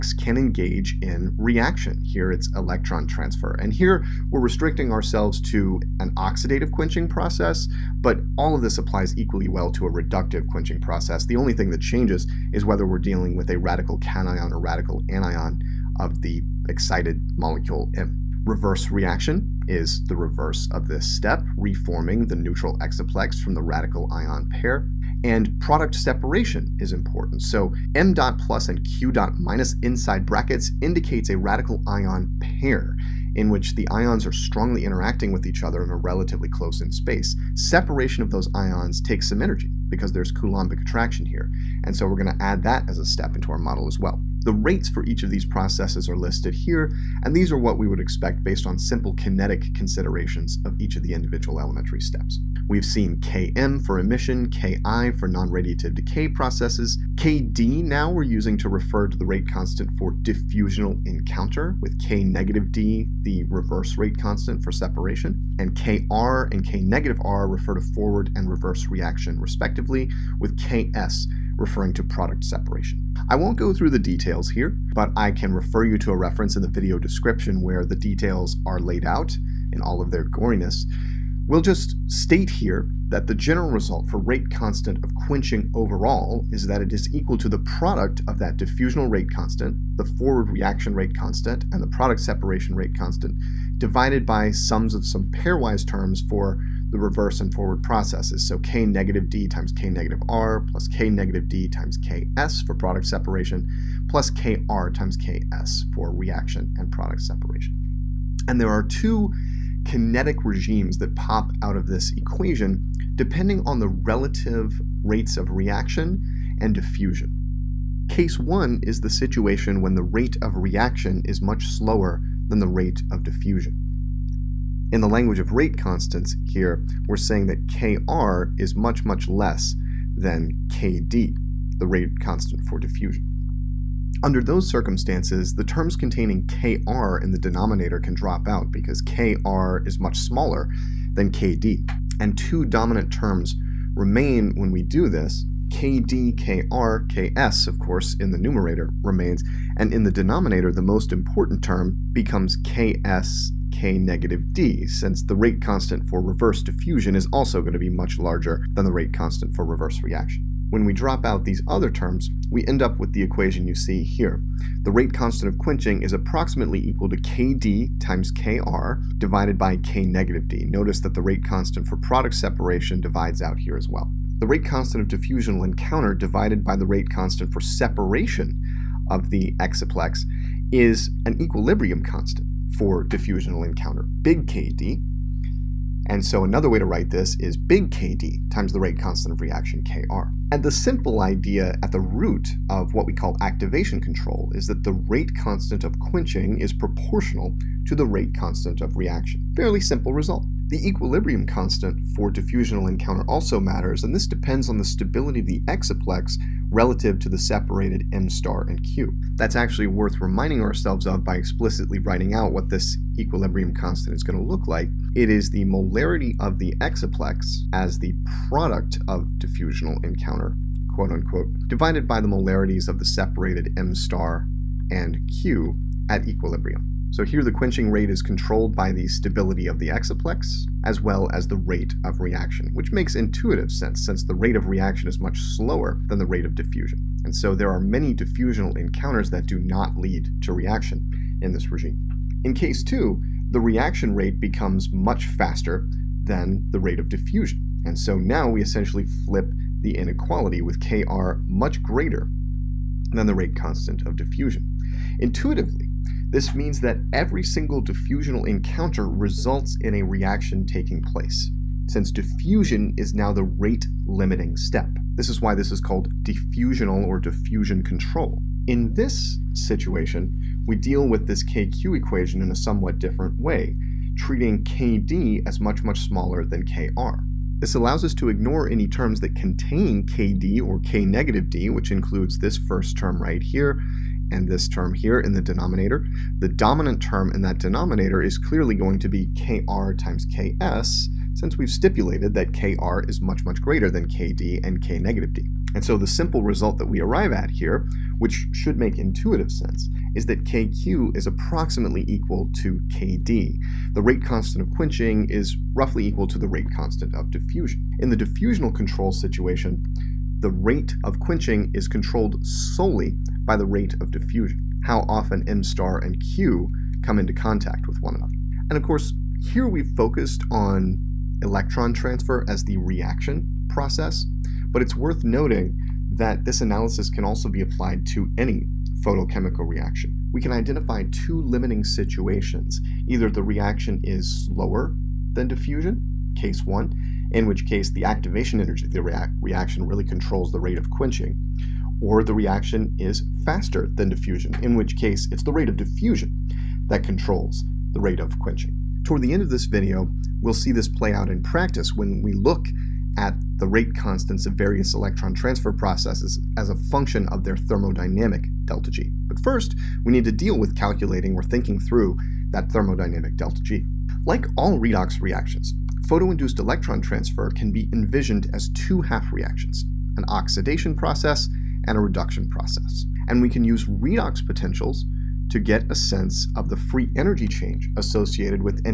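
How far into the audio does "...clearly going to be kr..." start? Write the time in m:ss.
4:48.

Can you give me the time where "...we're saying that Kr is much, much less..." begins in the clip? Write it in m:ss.
2:07.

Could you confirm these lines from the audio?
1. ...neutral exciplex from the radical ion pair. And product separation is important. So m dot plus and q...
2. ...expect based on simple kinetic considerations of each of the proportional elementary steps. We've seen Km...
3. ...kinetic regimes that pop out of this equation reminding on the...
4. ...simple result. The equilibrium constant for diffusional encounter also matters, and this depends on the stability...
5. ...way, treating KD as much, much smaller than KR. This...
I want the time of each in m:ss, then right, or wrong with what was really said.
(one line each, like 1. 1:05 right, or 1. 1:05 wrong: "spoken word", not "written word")
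1. 0:22 right
2. 0:47 wrong: "individual", not "proportional"
3. 1:49 wrong: "depending", not "reminding"
4. 3:19 right
5. 4:33 right.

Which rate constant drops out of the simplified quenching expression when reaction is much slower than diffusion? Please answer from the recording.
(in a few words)
product separation rate constant.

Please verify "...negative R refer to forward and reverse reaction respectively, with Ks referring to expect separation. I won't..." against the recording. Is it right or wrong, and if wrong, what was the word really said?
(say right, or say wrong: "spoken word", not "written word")
wrong: "product", not "expect".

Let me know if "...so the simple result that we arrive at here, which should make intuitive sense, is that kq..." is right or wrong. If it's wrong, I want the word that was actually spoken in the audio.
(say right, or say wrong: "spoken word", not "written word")
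right.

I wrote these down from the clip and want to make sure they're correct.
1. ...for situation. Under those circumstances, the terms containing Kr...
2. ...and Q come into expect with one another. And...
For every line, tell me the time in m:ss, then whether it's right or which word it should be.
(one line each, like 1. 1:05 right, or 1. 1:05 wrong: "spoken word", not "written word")
1. 2:12 wrong: "diffusion", not "situation"
2. 5:16 wrong: "contact", not "expect".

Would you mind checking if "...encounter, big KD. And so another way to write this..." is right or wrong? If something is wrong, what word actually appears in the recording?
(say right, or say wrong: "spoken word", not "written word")
right.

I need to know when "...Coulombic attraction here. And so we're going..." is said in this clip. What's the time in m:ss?
0:40.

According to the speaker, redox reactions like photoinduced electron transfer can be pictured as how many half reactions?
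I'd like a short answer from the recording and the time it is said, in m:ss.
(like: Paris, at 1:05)
2, at 6:08.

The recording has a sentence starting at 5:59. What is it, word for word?
But first, we need to deal with calculating or thinking through that thermodynamic delta G.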